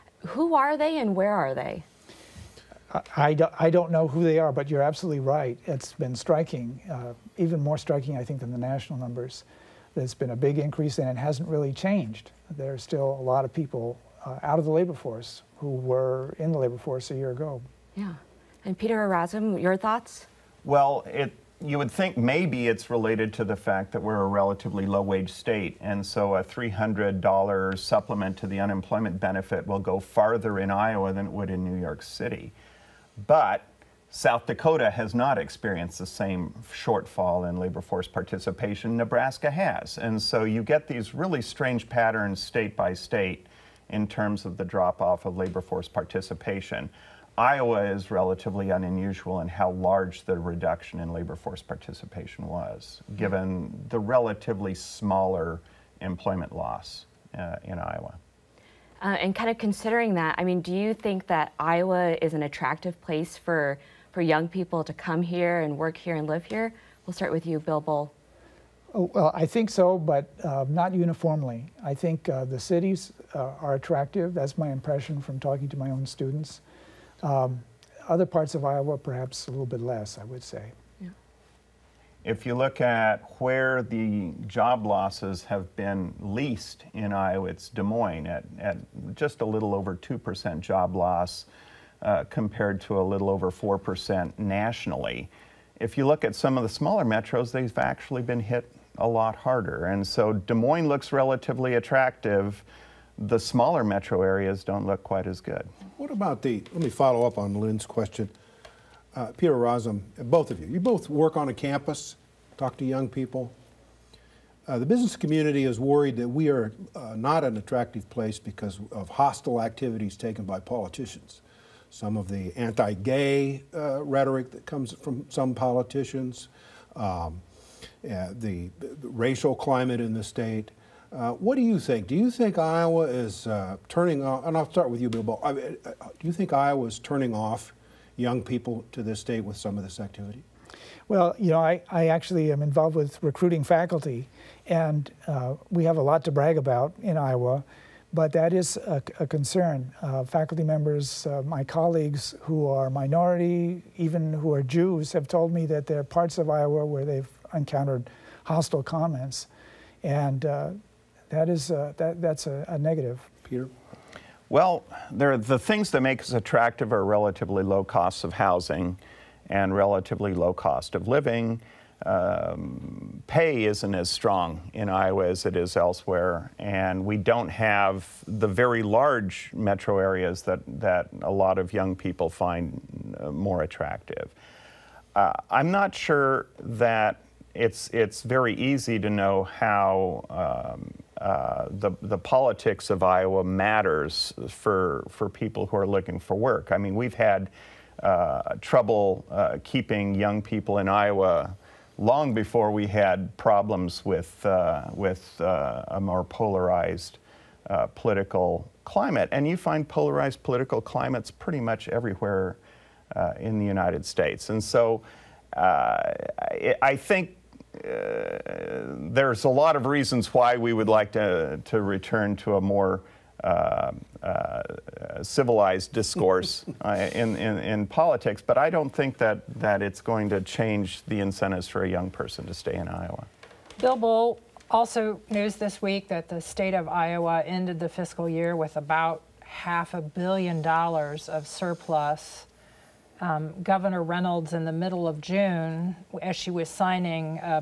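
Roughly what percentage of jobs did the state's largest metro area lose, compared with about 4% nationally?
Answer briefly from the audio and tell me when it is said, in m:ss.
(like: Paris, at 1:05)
2%, at 1:29.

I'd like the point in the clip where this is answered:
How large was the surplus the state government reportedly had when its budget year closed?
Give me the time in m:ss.
3:59.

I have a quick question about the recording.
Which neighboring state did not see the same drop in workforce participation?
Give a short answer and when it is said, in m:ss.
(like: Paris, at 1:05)
South Dakota, at 0:34.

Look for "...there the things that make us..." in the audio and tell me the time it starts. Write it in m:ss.
2:45.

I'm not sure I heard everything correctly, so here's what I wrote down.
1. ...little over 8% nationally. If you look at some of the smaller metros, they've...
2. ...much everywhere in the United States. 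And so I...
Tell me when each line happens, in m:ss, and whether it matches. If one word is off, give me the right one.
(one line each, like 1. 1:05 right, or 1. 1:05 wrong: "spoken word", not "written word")
1. 1:33 wrong: "4", not "8"
2. 3:31 right.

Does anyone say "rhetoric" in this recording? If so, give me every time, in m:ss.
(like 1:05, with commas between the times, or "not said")
2:04.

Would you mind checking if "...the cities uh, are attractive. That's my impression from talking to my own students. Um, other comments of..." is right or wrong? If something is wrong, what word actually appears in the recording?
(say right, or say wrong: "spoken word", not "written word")
wrong: "parts", not "comments".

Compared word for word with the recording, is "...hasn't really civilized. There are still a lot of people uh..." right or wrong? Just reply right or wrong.
wrong.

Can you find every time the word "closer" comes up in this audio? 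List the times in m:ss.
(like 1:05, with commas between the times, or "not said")
not said.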